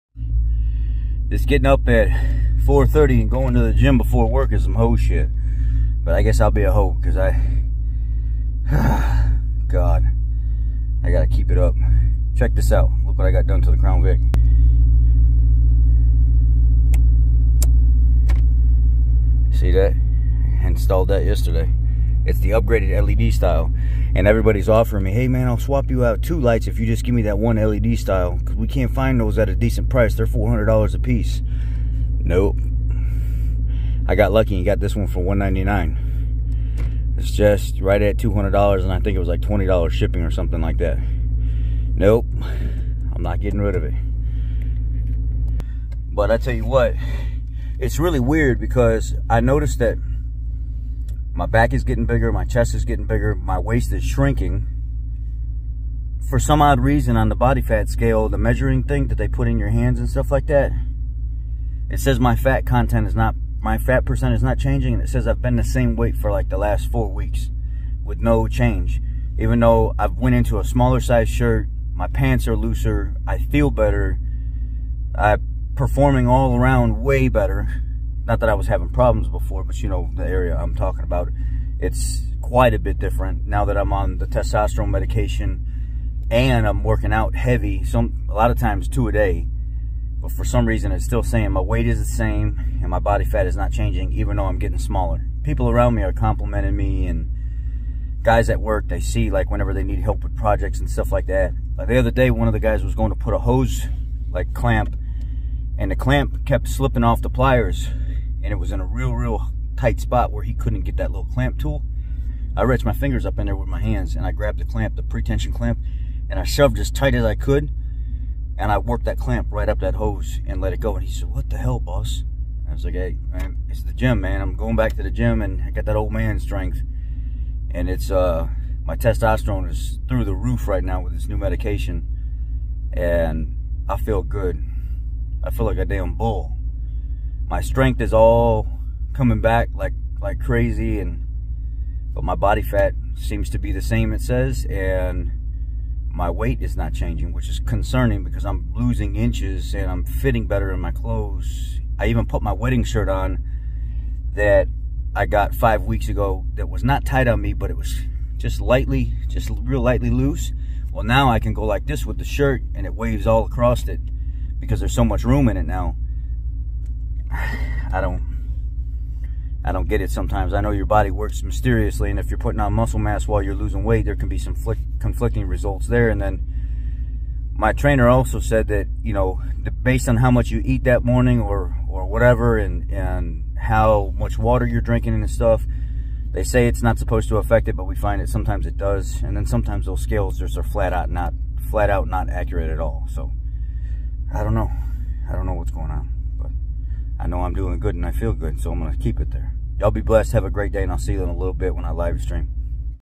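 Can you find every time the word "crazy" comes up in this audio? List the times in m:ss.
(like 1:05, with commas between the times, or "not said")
2:20.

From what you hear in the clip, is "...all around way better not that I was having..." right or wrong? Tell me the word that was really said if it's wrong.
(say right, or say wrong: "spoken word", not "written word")
right.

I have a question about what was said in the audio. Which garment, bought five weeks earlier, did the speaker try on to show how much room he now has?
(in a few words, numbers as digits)
wedding shirt.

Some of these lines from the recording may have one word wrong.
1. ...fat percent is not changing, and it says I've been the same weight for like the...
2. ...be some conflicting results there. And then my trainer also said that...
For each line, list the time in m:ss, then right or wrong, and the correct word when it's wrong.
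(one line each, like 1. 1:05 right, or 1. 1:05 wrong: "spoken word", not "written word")
1. 1:03 right
2. 2:54 right.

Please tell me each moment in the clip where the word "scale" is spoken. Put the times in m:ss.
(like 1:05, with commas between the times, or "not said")
0:57, 3:10.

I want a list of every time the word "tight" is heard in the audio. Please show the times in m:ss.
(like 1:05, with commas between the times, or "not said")
1:49, 1:56, 2:37.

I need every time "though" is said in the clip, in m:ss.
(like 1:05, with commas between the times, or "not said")
1:09, 1:34.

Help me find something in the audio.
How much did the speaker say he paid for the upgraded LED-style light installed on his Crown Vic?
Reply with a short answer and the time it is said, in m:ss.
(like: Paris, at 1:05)
$199, at 0:35.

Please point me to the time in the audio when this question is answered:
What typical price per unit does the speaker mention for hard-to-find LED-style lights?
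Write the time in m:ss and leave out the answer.
0:30.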